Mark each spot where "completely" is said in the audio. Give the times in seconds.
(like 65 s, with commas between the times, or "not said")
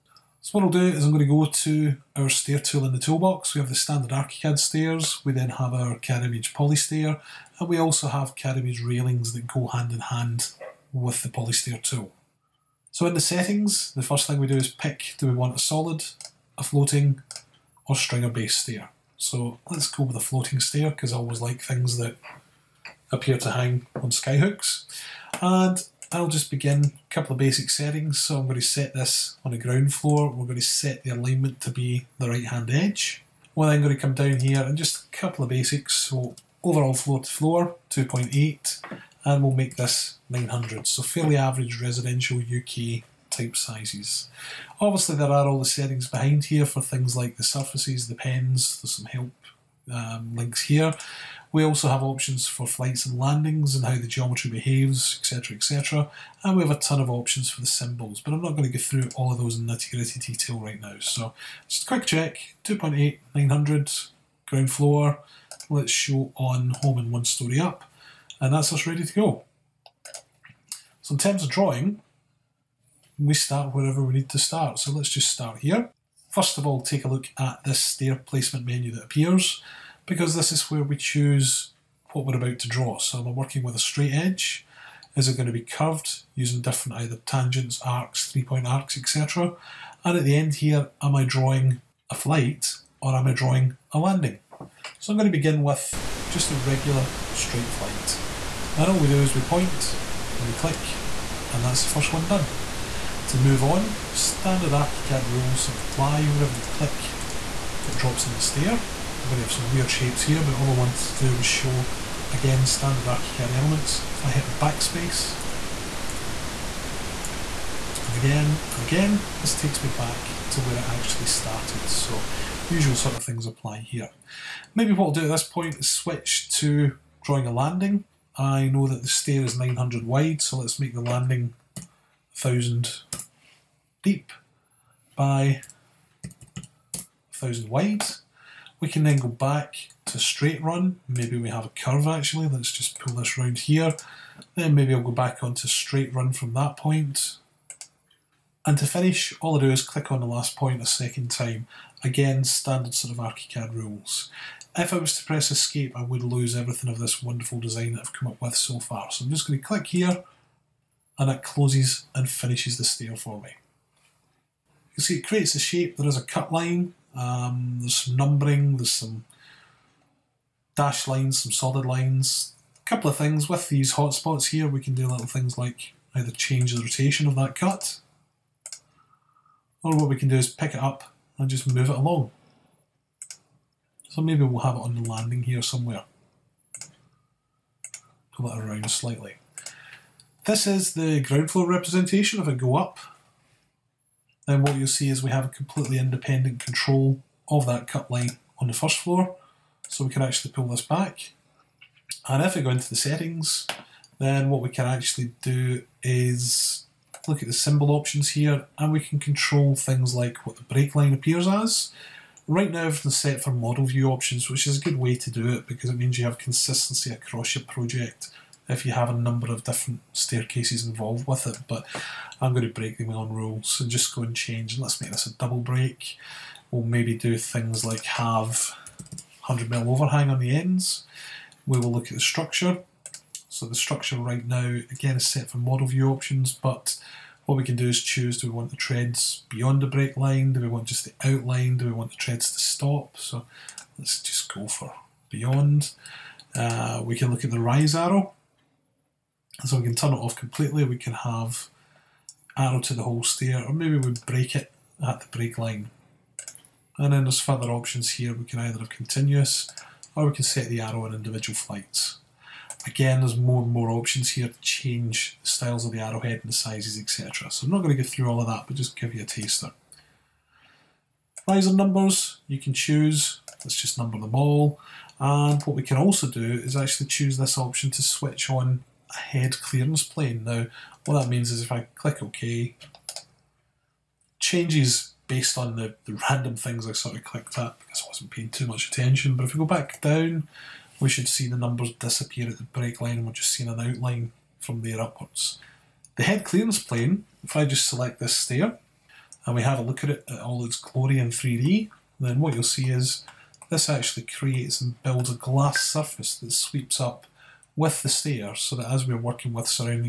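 195 s, 250 s.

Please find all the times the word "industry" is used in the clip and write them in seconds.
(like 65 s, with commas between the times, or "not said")
not said.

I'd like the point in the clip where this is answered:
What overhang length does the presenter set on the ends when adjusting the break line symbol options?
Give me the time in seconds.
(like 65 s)
229 s.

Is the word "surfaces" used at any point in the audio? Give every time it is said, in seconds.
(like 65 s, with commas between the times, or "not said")
47 s, 305 s.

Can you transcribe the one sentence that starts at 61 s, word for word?
So just a quick check, 2.8, 900, ground floor.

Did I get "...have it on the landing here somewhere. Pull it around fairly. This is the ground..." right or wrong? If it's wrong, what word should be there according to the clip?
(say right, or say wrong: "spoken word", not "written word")
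wrong: "slightly", not "fairly".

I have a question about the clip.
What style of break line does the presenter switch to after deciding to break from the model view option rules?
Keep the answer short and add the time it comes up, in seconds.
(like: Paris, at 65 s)
Double break, at 225 s.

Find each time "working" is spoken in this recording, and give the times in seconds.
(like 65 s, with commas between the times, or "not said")
83 s, 309 s.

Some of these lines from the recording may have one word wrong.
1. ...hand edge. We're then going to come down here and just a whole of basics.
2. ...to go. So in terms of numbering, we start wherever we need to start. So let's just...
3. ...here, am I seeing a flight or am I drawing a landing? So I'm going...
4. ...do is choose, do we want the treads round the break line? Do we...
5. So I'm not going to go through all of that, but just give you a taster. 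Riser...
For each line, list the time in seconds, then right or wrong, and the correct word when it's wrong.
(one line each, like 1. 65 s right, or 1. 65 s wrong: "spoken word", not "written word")
1. 32 s wrong: "couple", not "whole"
2. 69 s wrong: "drawing", not "numbering"
3. 90 s wrong: "drawing", not "seeing"
4. 237 s wrong: "beyond", not "round"
5. 267 s right.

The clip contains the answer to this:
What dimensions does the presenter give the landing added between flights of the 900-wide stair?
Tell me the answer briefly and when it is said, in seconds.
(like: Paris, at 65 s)
1000 by 1000, at 132 s.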